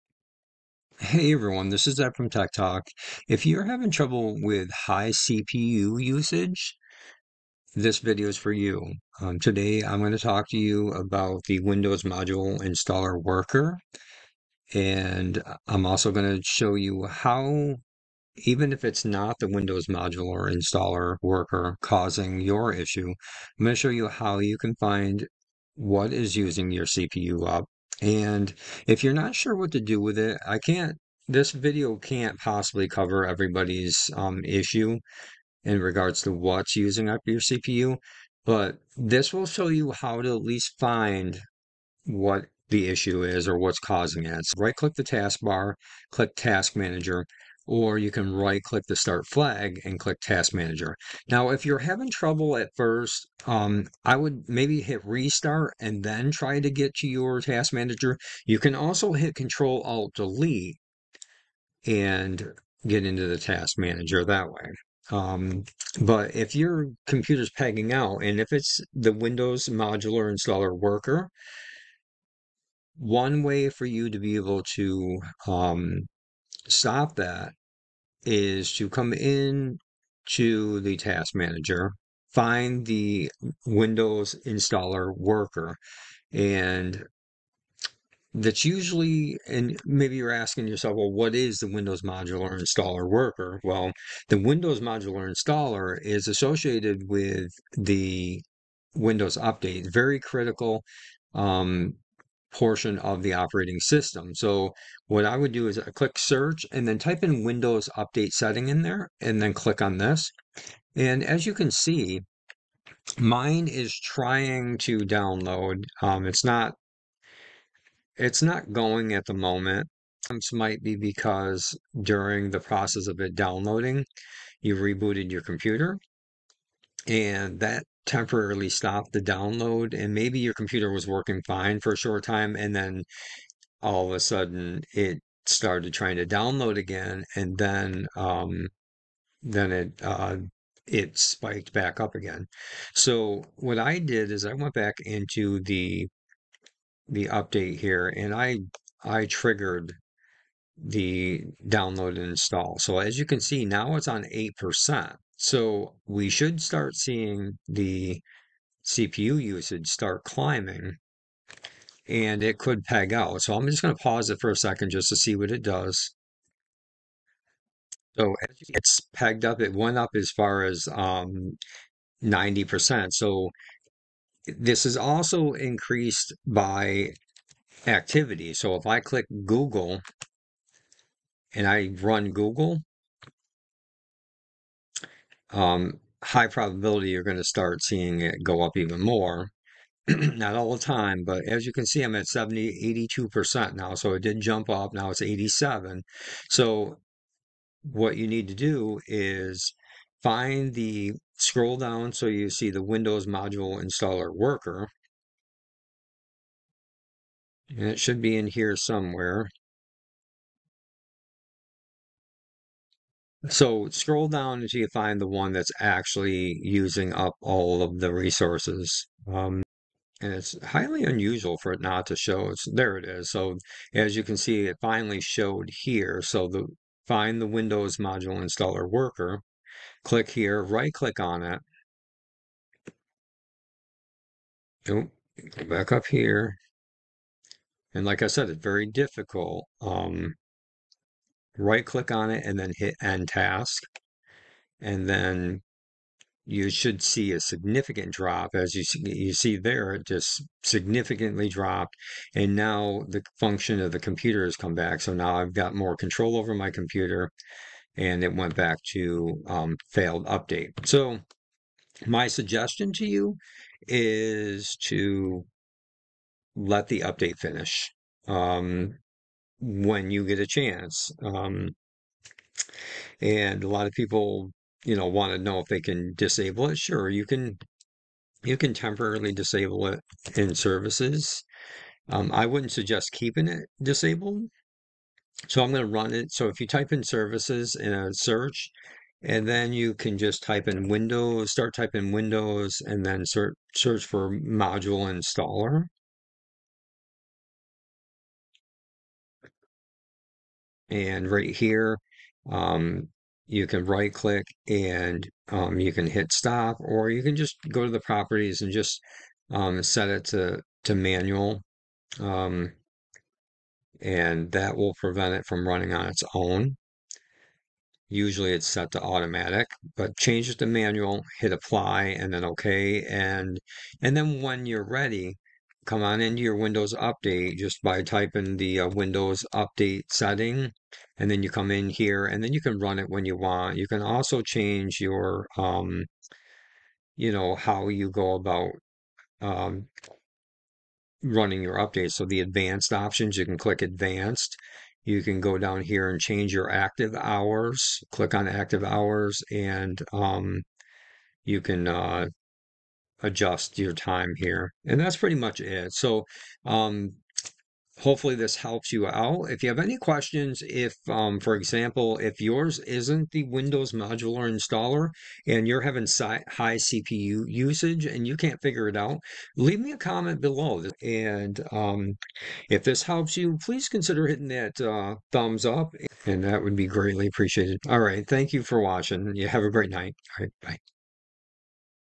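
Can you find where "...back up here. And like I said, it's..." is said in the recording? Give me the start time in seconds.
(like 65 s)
235 s.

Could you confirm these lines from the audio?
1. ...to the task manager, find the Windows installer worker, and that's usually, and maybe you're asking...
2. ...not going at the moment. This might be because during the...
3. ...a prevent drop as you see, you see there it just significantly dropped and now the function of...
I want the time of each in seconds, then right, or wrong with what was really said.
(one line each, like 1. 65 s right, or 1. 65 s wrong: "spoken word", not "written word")
1. 80 s right
2. 118 s right
3. 247 s wrong: "significant", not "prevent".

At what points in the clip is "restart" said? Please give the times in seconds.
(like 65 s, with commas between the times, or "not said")
55 s.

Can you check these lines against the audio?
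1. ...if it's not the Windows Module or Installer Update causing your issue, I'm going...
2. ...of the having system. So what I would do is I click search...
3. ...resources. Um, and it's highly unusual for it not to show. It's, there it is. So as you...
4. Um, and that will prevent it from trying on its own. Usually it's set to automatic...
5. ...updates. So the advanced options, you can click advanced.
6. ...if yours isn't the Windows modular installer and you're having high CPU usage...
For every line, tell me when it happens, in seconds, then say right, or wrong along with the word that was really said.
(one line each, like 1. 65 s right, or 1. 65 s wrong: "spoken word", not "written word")
1. 18 s wrong: "Worker", not "Update"
2. 102 s wrong: "operating", not "having"
3. 218 s right
4. 312 s wrong: "running", not "trying"
5. 341 s right
6. 362 s right.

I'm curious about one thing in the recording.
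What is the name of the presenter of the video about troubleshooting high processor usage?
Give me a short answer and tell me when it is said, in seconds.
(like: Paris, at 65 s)
Ed, at 1 s.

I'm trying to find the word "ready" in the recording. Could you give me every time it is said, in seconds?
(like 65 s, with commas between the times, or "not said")
324 s.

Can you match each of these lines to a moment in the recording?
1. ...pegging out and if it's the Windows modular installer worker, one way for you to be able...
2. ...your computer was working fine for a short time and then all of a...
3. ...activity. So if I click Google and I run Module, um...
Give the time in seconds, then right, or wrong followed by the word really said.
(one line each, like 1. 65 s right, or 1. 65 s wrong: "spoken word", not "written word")
1. 67 s right
2. 130 s right
3. 177 s wrong: "Google", not "Module".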